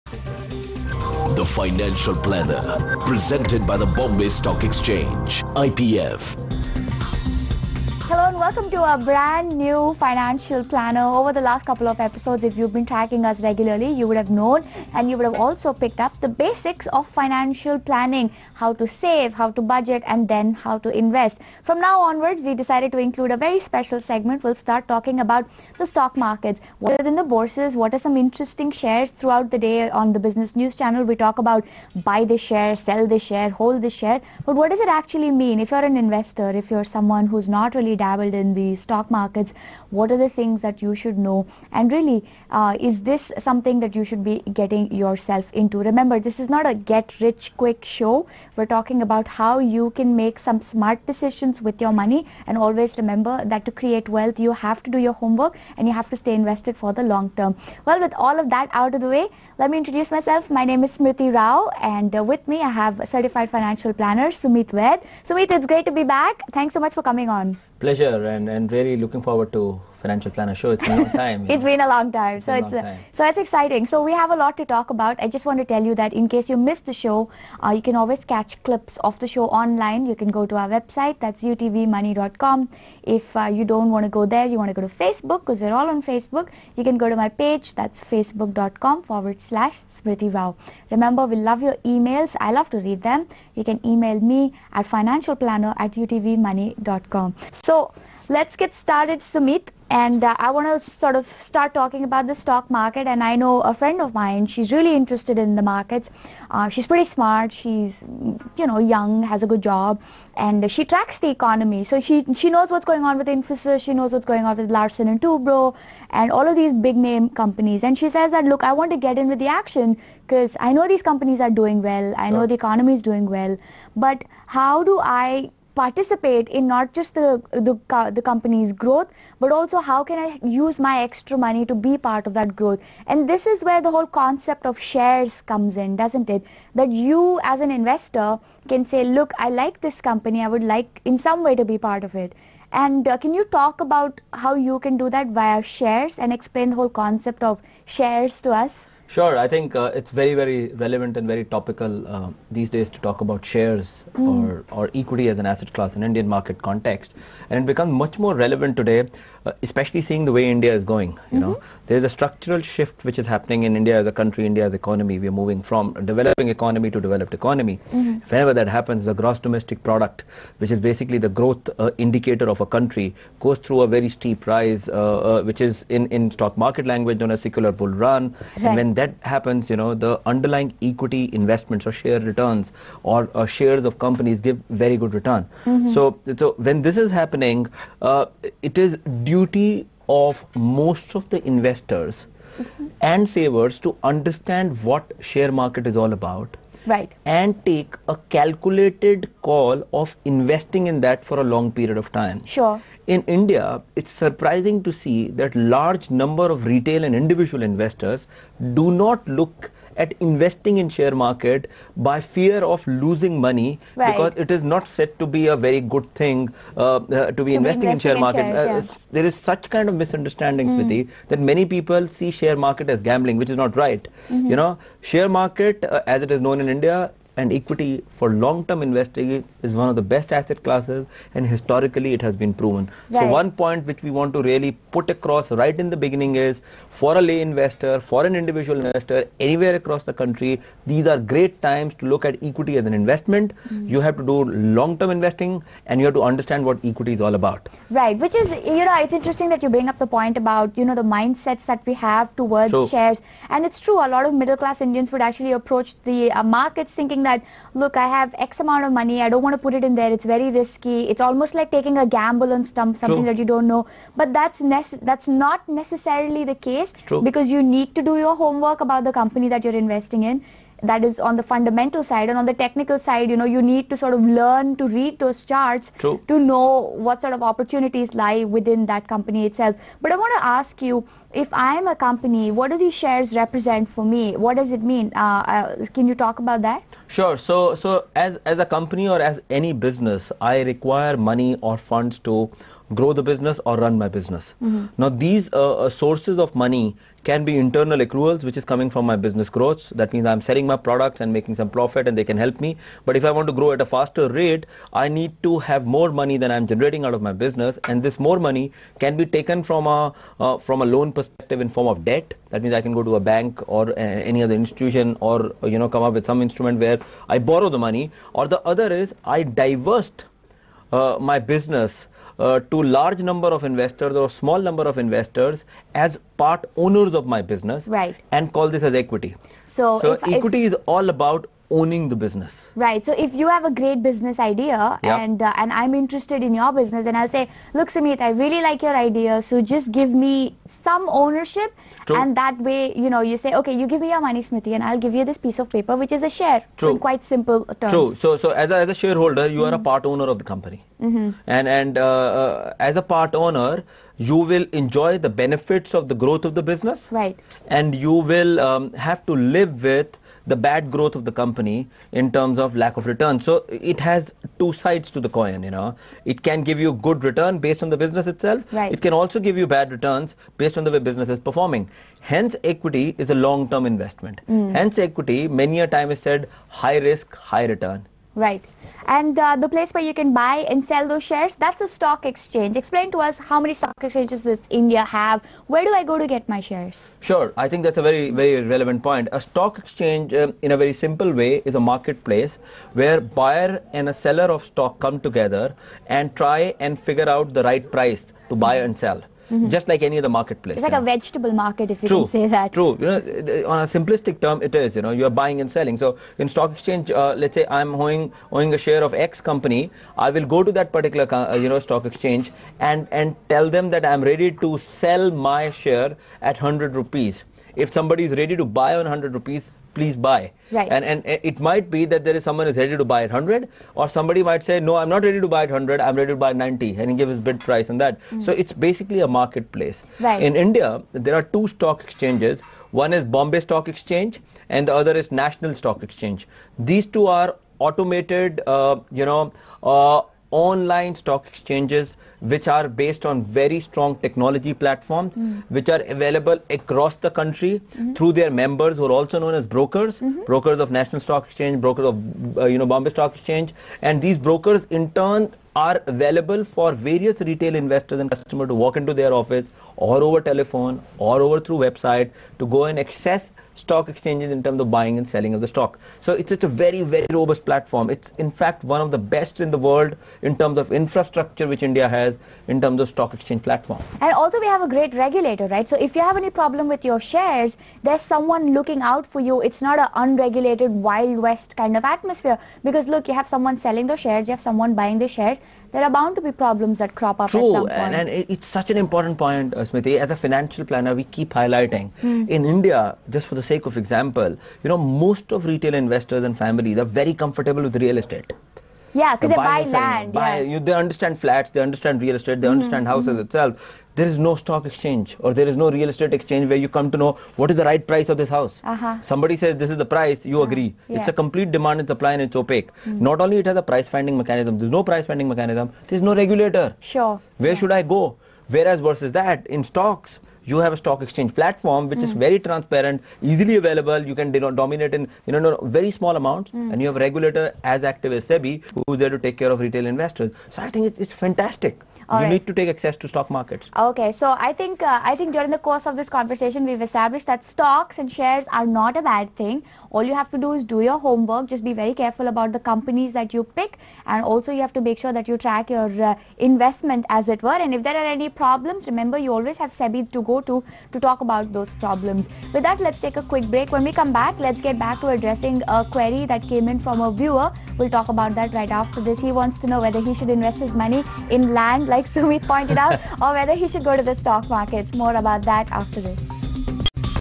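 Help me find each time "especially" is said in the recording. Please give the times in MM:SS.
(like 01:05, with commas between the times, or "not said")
02:39.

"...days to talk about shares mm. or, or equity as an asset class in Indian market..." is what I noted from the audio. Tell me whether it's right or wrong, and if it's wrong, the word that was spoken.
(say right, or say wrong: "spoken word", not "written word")
right.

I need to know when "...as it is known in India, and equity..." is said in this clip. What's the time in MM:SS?
03:46.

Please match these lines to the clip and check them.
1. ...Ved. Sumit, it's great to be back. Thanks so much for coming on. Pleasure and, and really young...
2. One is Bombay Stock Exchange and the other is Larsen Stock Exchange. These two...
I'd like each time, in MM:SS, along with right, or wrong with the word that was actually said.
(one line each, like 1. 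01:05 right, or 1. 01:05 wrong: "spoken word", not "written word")
1. 01:04 wrong: "looking", not "young"
2. 07:12 wrong: "National", not "Larsen".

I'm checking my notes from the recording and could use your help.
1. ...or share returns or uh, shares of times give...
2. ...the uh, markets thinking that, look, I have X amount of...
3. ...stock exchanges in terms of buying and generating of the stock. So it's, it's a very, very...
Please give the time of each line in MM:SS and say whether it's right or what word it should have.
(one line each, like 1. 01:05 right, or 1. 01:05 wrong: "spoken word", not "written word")
1. 03:01 wrong: "companies", not "times"
2. 04:16 right
3. 07:43 wrong: "selling", not "generating".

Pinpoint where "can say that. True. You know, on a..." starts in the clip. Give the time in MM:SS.
06:42.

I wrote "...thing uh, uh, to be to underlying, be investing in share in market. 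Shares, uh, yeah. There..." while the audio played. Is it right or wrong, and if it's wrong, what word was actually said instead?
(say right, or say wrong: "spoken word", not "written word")
wrong: "investing", not "underlying".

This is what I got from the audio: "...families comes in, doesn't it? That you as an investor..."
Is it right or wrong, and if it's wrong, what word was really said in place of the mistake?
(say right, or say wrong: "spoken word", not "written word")
wrong: "shares", not "families".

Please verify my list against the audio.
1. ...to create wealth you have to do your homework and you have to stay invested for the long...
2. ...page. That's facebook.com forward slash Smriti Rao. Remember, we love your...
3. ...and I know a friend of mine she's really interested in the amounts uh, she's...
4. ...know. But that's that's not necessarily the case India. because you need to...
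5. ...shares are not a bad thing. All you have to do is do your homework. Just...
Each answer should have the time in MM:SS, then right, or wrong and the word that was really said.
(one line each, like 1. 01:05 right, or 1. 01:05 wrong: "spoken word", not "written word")
1. 00:53 right
2. 01:27 right
3. 01:43 wrong: "markets", not "amounts"
4. 04:23 wrong: "True", not "India"
5. 08:58 right.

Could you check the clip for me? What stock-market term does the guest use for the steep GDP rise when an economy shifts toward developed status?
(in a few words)
Secular bull run.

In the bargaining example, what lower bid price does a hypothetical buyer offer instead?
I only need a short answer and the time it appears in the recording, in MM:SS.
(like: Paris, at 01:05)
90, at 07:06.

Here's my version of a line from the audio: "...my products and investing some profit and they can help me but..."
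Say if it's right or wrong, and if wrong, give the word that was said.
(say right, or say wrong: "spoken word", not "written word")
wrong: "making", not "investing".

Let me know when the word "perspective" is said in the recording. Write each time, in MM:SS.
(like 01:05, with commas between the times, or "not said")
05:11.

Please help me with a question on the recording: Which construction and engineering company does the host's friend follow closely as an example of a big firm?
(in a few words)
Larsen and Toubro.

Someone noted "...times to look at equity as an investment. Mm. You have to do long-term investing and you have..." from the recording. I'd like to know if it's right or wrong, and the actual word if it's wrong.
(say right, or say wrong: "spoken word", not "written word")
right.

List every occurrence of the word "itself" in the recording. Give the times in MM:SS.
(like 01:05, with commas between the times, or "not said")
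04:39, 06:08, 08:23.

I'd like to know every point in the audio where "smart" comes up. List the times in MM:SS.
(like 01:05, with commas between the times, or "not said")
00:50, 01:47.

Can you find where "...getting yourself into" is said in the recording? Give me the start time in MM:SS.
00:44.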